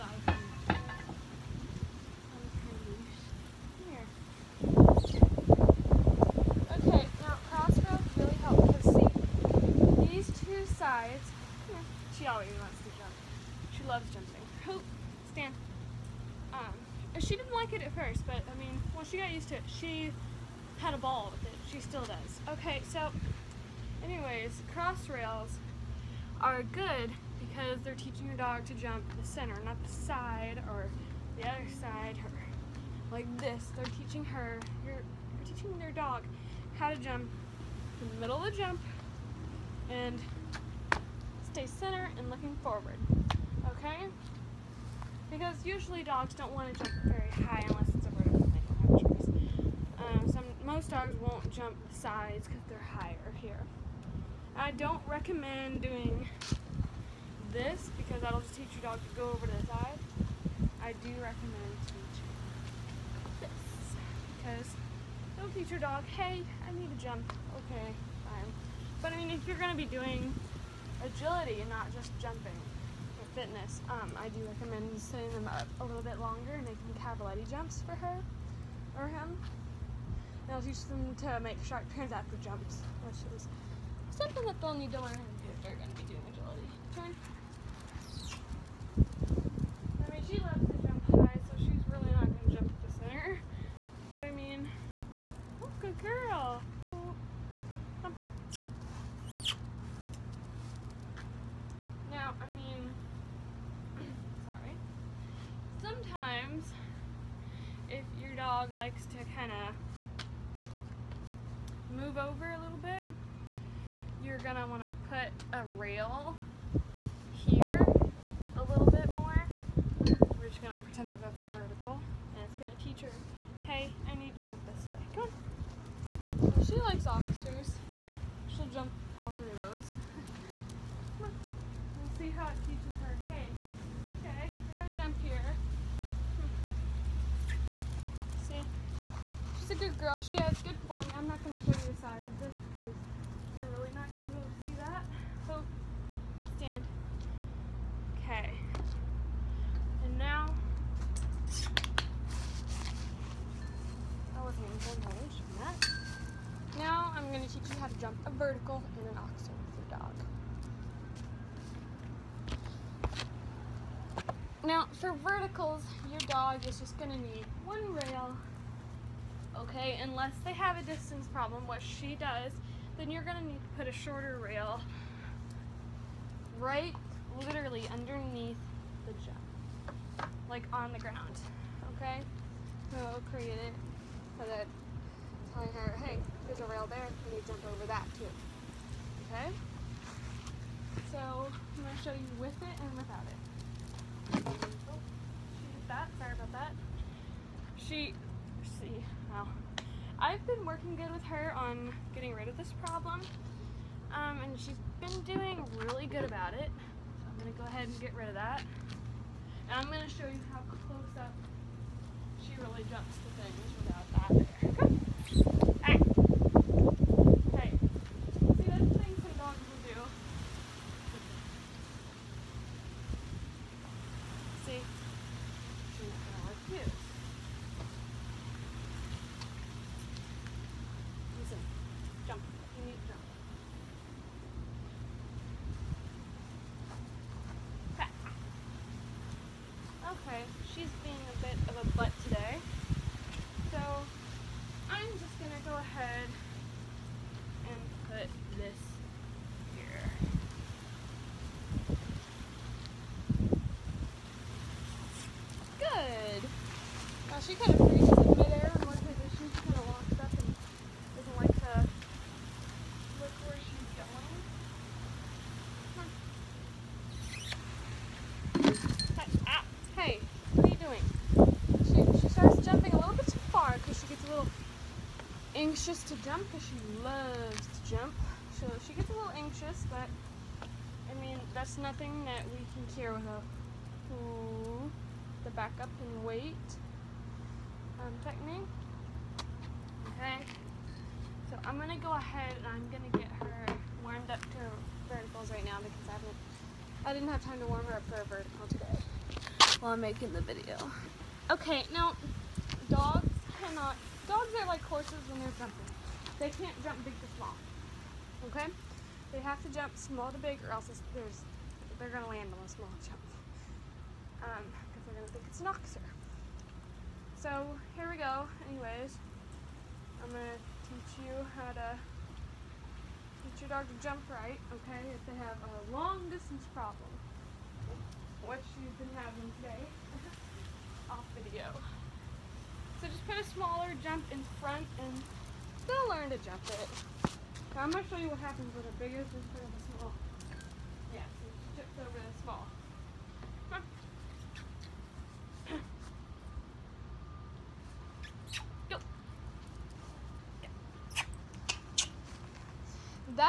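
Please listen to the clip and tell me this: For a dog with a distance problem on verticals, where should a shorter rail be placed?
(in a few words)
On the ground.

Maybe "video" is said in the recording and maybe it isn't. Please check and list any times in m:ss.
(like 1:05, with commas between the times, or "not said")
5:00, 5:31.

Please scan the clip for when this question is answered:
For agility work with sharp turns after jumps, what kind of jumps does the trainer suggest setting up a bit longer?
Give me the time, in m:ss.
1:17.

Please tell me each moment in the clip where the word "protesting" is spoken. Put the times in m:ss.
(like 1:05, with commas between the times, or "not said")
not said.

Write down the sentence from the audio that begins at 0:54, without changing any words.
I don't recommend doing this because that'll just teach your dog to go over to the side.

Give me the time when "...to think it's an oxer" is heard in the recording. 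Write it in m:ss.
5:15.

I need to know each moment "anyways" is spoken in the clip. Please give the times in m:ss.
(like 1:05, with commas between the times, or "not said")
0:24, 5:18.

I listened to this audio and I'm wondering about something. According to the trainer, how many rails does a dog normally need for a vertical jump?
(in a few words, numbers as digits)
1.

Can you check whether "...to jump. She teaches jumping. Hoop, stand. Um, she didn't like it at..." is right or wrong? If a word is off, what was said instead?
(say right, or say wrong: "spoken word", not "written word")
wrong: "loves", not "teaches".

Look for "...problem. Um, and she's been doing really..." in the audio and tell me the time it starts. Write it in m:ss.
3:22.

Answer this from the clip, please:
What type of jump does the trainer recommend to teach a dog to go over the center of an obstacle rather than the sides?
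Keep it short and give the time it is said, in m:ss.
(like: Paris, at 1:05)
Cross rails, at 0:24.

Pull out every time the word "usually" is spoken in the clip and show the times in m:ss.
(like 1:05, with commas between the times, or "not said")
0:45.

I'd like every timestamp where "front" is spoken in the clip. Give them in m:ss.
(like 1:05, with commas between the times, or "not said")
5:34, 5:39.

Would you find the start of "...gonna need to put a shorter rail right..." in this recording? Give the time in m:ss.
2:53.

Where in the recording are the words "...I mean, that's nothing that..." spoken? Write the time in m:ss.
4:40.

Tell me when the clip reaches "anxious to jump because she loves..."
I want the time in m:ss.
4:35.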